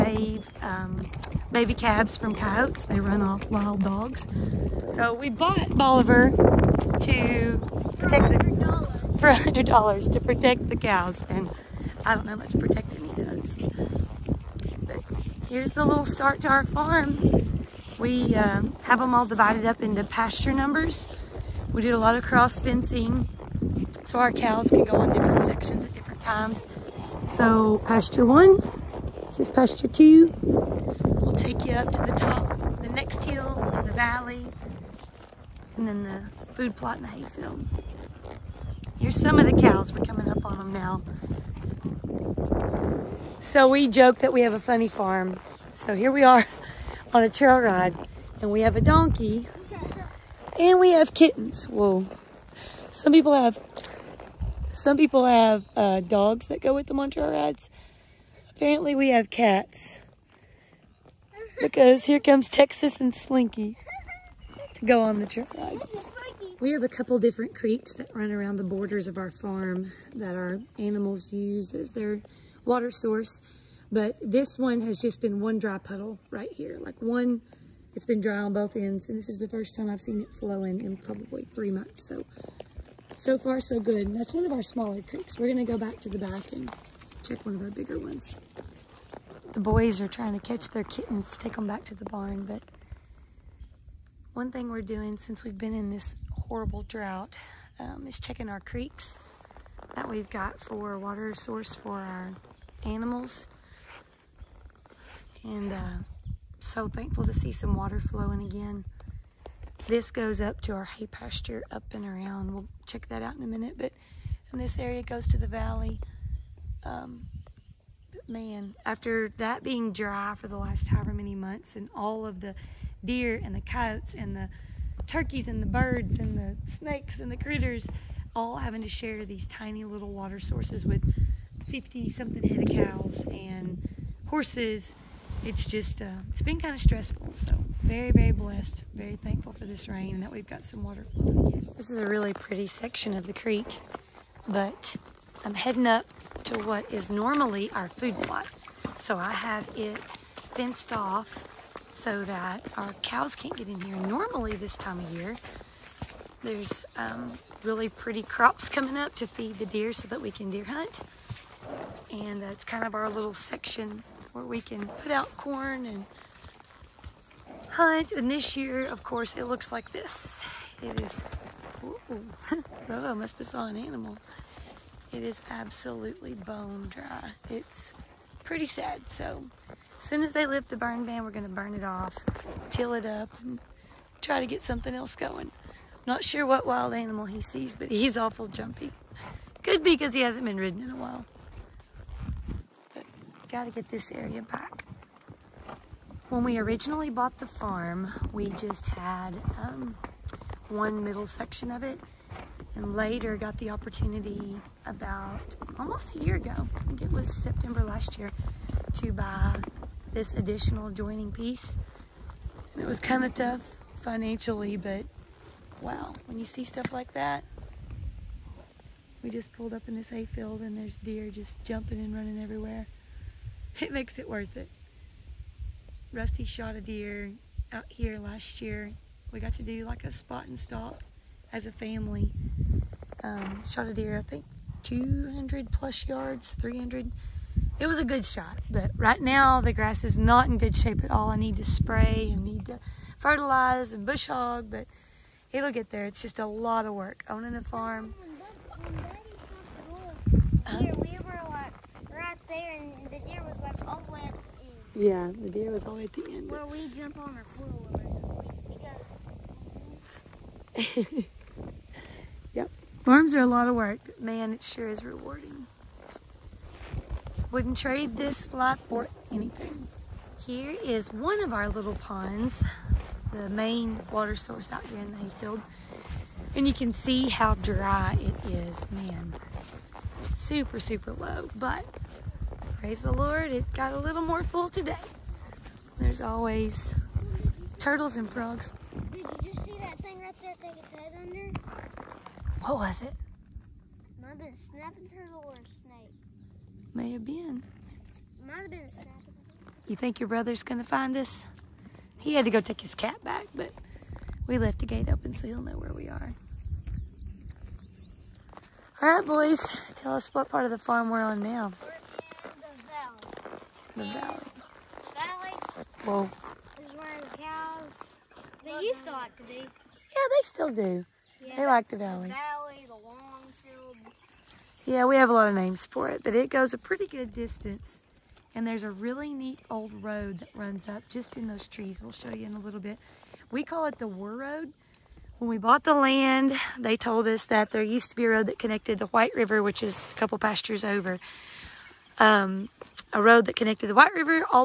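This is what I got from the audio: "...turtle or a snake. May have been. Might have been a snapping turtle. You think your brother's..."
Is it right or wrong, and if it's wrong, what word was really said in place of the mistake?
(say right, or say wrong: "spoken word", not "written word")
right.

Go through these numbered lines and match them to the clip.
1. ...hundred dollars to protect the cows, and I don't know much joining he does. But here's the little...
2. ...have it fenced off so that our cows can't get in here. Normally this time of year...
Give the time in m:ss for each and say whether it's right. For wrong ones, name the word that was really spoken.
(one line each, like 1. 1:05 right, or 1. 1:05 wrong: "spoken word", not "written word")
1. 0:09 wrong: "protecting", not "joining"
2. 2:29 right.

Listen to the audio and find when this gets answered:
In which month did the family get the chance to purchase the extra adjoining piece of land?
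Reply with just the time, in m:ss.
3:27.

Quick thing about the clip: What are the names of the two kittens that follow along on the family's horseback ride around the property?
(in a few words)
Texas and Slinky.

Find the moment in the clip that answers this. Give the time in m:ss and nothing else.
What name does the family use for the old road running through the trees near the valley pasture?
5:34.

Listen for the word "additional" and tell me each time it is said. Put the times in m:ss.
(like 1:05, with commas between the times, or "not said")
3:30.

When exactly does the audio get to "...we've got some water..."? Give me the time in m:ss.
2:20.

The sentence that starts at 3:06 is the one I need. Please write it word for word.
Not sure what wild animal he sees, but he's awful jumpy.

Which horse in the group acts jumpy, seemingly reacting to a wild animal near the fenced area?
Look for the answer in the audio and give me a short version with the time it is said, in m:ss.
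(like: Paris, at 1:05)
Rojo, at 2:52.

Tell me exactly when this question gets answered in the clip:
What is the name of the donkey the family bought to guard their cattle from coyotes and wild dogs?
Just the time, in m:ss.
0:05.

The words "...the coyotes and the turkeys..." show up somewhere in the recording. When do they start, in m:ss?
2:03.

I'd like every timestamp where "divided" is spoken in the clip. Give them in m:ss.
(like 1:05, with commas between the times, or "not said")
0:19.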